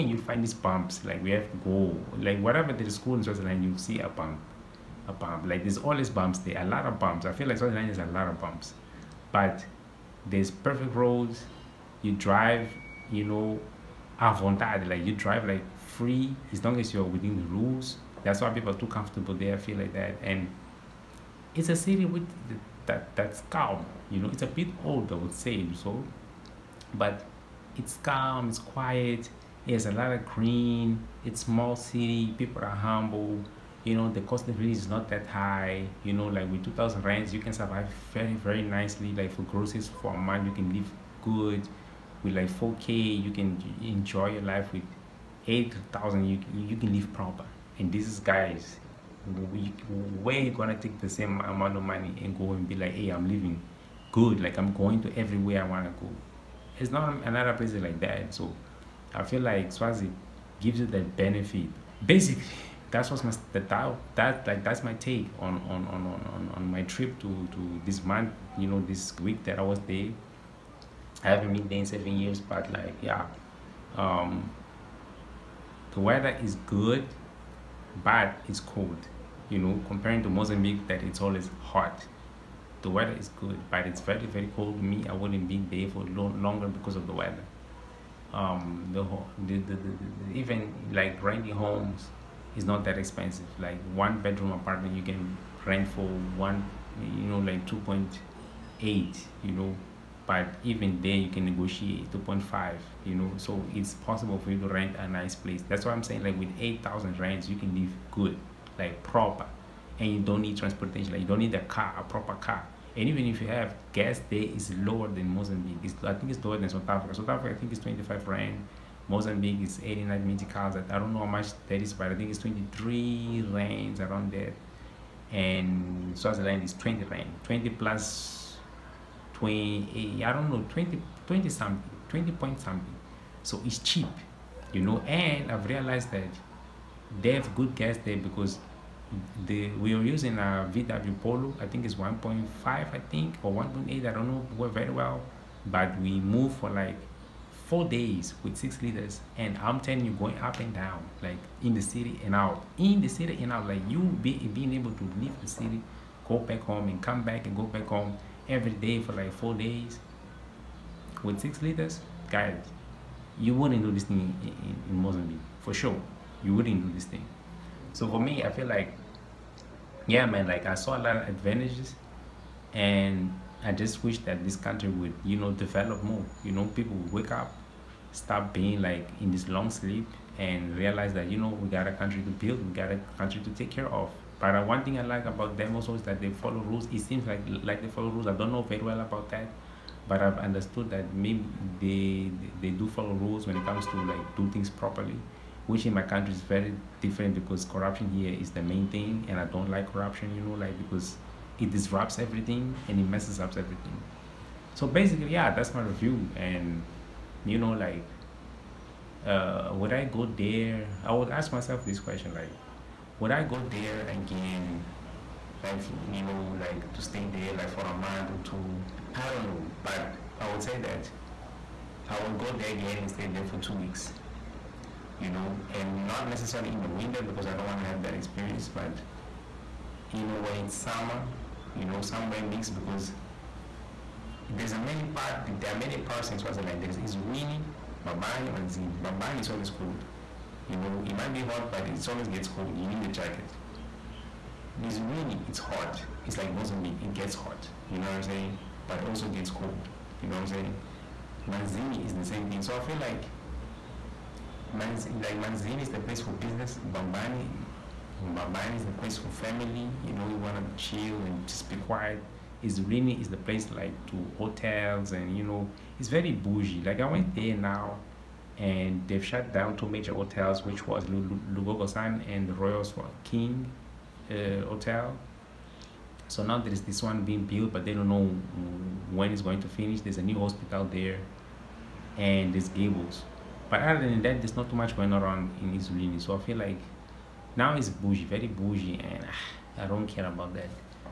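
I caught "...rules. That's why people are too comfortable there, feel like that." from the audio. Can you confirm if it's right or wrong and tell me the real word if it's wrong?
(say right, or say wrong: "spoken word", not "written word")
right.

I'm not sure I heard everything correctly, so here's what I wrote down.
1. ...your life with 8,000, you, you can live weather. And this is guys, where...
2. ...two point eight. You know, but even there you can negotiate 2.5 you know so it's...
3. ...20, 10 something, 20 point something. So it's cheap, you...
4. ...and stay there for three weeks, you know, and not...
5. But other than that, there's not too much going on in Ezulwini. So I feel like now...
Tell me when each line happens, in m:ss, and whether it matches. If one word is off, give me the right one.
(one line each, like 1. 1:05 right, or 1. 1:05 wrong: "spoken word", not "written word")
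1. 0:44 wrong: "proper", not "weather"
2. 1:37 right
3. 2:10 wrong: "20", not "10"
4. 3:42 wrong: "two", not "three"
5. 4:43 right.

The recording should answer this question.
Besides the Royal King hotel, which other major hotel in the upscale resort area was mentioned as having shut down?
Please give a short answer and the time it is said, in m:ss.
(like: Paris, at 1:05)
Lugogo Sun, at 4:31.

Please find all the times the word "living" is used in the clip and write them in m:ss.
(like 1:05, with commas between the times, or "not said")
0:34, 0:53.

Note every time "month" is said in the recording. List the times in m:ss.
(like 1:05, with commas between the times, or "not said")
0:40, 1:08, 3:37.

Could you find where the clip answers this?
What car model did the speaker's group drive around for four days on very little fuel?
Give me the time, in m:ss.
2:20.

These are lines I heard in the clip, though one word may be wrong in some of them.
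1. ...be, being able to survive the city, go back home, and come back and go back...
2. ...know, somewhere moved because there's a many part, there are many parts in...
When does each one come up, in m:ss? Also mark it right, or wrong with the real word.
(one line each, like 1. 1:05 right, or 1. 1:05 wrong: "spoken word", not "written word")
1. 2:33 wrong: "leave", not "survive"
2. 3:51 wrong: "mixed", not "moved".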